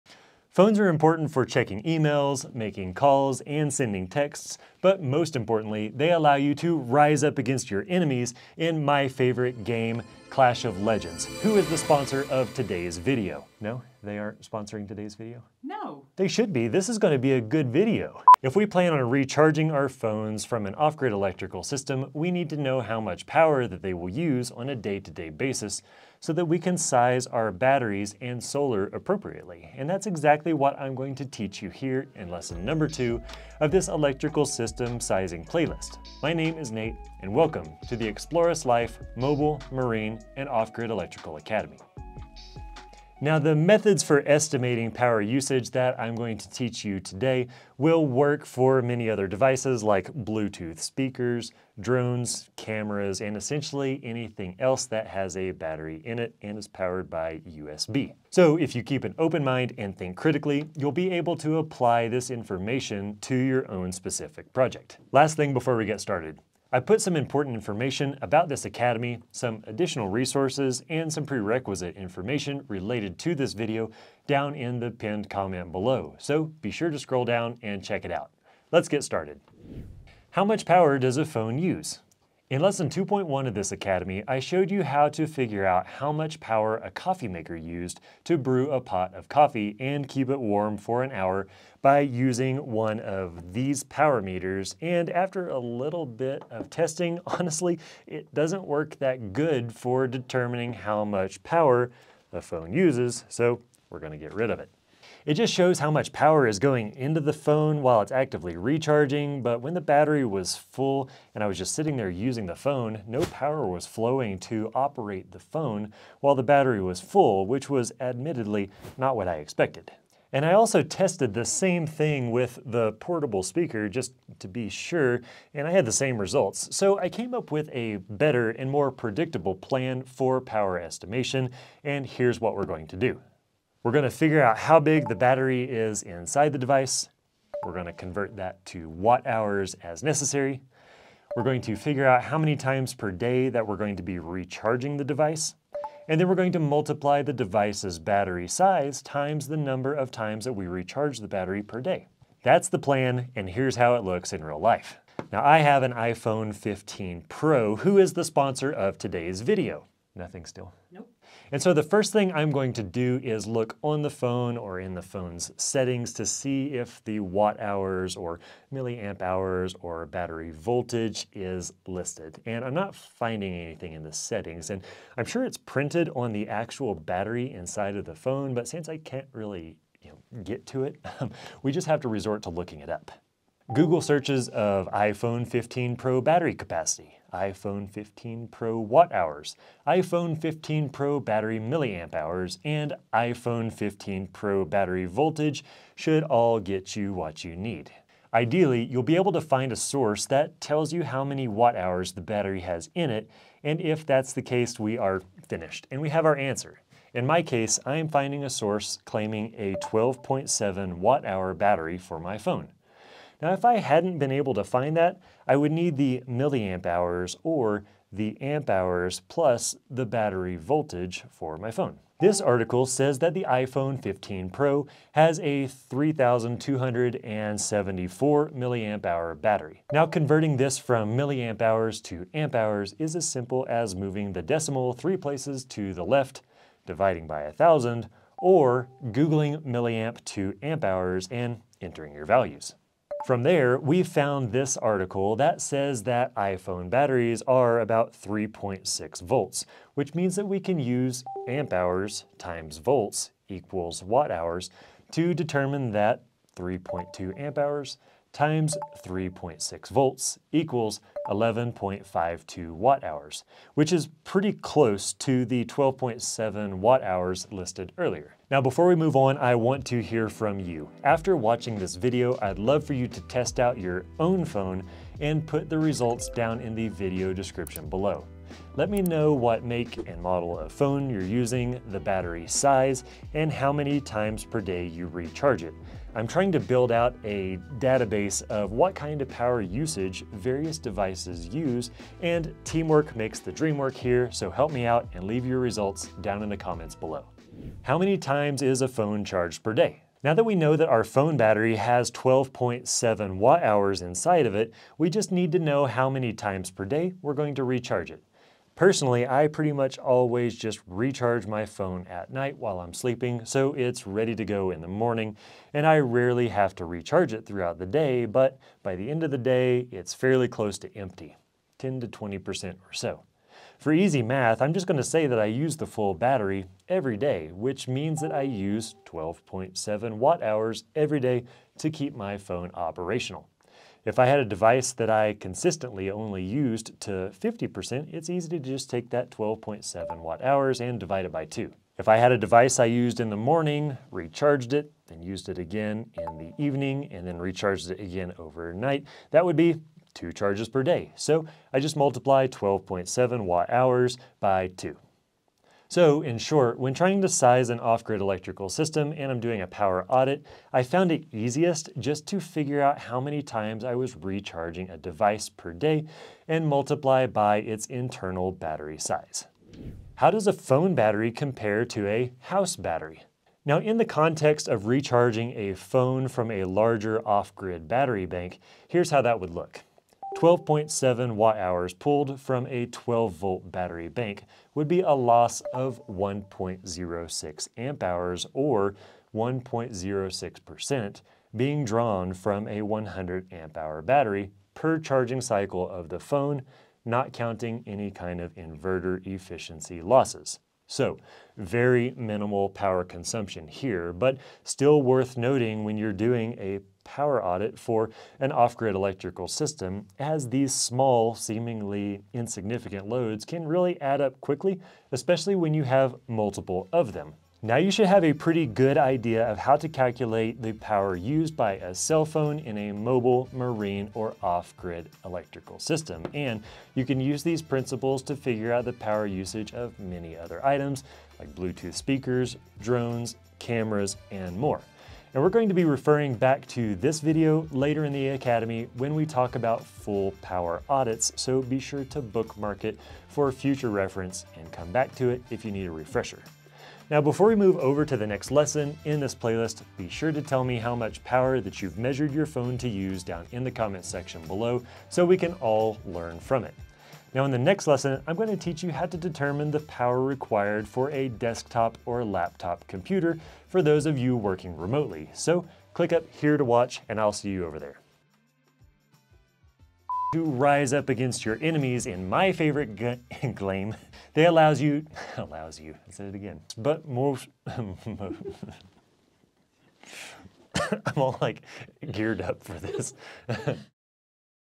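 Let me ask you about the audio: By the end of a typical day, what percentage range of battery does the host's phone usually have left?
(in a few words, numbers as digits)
10 to 20%.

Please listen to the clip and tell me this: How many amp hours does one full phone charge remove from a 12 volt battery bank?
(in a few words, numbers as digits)
1.06 amp hours.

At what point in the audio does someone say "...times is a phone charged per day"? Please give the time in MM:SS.
04:58.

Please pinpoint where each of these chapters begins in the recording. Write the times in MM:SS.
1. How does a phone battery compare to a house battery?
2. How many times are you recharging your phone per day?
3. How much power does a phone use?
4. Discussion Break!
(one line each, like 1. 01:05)
1. 06:11
2. 05:02
3. 01:20
4. 04:29.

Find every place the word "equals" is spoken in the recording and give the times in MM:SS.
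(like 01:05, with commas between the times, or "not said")
04:13, 04:20.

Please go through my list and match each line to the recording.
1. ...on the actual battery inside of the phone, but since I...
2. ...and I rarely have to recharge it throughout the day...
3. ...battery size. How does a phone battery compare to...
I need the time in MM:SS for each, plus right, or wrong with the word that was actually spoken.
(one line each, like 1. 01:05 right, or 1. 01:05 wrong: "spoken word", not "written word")
1. 02:56 right
2. 05:15 right
3. 06:08 right.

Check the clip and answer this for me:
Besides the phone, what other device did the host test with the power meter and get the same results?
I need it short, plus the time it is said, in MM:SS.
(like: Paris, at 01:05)
portable speaker, at 02:02.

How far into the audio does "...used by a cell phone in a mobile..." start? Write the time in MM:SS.
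07:01.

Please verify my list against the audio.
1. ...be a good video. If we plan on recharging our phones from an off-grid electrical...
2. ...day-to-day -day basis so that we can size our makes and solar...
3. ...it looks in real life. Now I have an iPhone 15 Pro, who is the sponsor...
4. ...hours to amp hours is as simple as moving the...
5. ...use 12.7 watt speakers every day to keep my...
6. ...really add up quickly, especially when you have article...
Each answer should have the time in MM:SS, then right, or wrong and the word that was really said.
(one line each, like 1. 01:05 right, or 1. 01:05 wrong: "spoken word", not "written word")
1. 00:17 right
2. 00:24 wrong: "batteries", not "makes"
3. 02:33 right
4. 03:51 right
5. 05:28 wrong: "hours", not "speakers"
6. 06:53 wrong: "multiple", not "article".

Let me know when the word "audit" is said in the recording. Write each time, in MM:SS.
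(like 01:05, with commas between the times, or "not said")
06:00, 06:47, 07:20.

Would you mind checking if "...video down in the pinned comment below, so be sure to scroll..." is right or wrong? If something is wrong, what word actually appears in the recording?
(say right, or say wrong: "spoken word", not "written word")
right.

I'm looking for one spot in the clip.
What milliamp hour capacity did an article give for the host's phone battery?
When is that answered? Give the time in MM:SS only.
03:45.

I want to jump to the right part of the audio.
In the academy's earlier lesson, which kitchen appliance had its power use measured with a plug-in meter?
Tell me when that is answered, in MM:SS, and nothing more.
01:26.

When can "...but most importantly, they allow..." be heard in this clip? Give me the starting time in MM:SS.
00:04.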